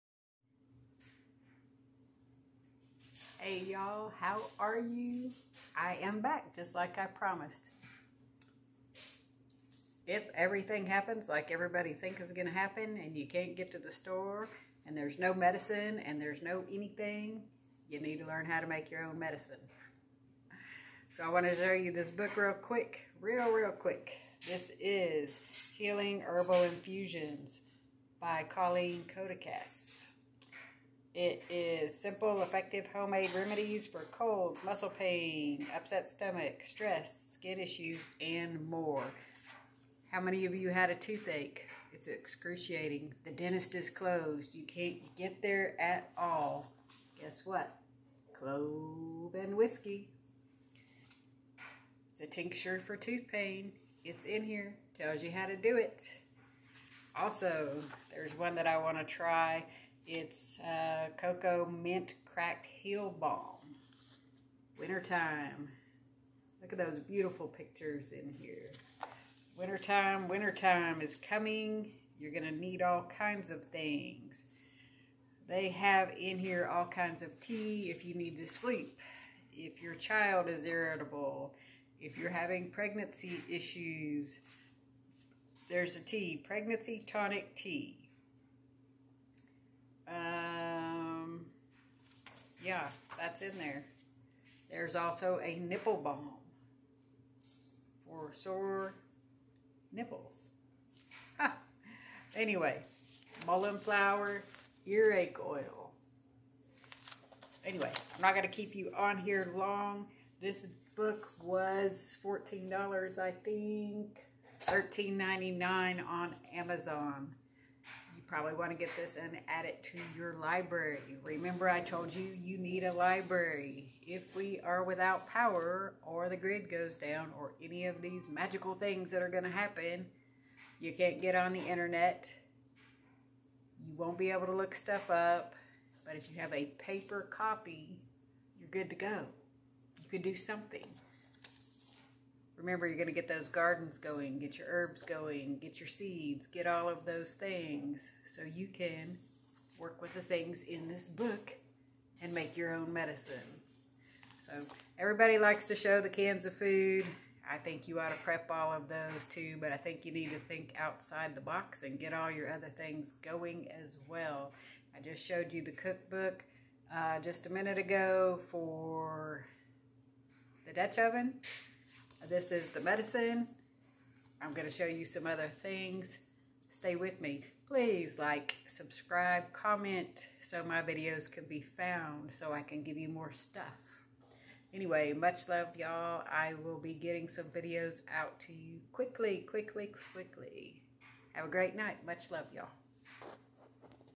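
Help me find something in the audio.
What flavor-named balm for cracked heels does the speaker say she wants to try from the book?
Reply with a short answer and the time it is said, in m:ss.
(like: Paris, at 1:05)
Cocoa Mint, at 1:01.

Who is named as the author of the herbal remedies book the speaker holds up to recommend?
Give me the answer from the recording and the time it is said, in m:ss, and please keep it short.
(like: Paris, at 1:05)
Colleen Codekas, at 0:28.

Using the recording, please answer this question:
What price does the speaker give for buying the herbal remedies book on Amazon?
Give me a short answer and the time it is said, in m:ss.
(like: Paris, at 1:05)
$13.99, at 1:54.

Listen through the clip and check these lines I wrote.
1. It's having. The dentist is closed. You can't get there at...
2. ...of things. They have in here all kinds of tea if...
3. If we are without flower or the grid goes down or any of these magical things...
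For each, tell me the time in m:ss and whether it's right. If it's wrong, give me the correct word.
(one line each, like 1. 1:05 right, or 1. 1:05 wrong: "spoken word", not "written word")
1. 0:41 wrong: "excruciating", not "having"
2. 1:13 right
3. 2:04 wrong: "power", not "flower".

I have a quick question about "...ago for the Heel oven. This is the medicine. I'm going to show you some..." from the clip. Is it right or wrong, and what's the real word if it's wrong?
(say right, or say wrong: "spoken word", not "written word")
wrong: "Dutch", not "Heel".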